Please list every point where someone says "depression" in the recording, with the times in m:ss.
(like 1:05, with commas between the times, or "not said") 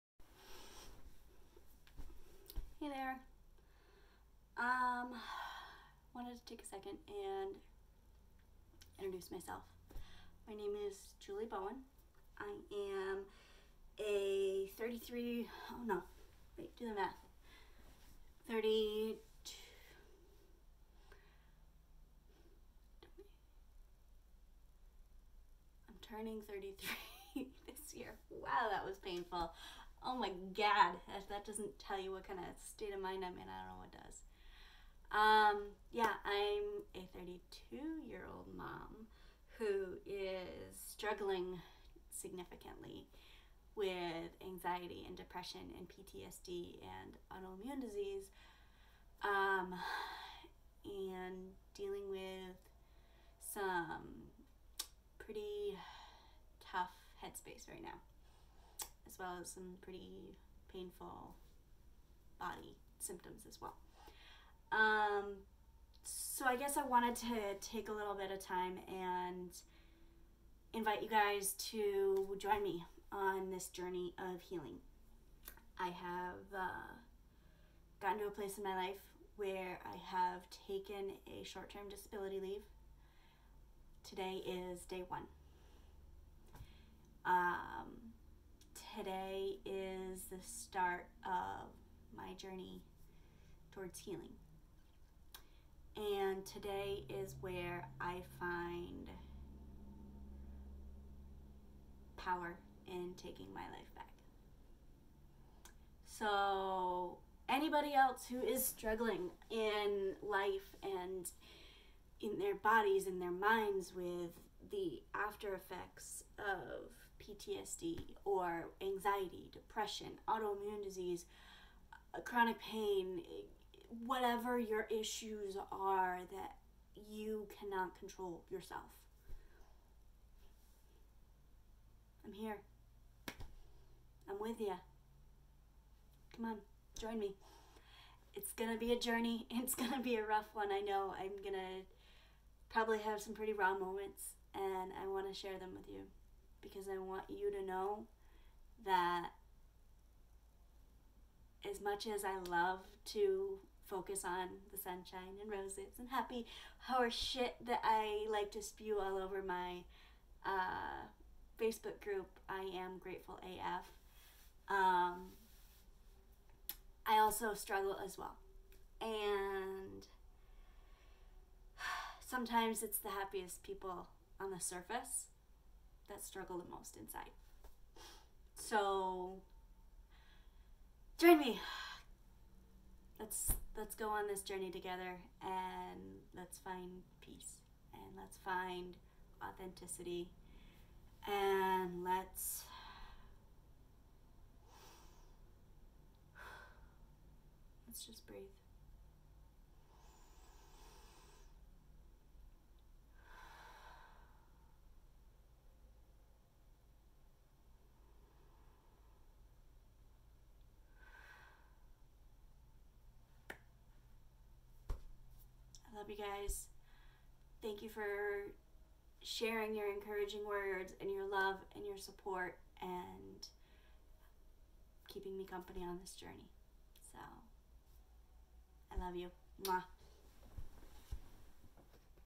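0:45, 1:59.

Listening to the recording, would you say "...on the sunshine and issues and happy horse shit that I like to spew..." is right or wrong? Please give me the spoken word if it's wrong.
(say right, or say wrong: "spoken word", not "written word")
wrong: "roses", not "issues".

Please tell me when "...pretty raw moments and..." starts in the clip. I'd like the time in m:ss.
2:23.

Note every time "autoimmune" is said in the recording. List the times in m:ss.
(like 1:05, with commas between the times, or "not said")
0:47, 2:00.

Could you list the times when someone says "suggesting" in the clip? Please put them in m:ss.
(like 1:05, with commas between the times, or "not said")
not said.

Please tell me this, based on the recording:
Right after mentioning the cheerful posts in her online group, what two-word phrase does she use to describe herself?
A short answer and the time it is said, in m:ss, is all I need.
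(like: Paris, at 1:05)
grateful AF, at 2:42.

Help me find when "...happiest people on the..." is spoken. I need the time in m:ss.
2:53.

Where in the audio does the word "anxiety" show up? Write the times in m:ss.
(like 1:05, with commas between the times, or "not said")
0:44, 1:58.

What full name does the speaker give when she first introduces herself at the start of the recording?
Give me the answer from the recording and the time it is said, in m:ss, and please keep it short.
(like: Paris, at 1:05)
Julie Bowen, at 0:11.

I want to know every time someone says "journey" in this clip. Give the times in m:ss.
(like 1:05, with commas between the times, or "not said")
1:13, 1:32, 2:18, 3:04, 3:46.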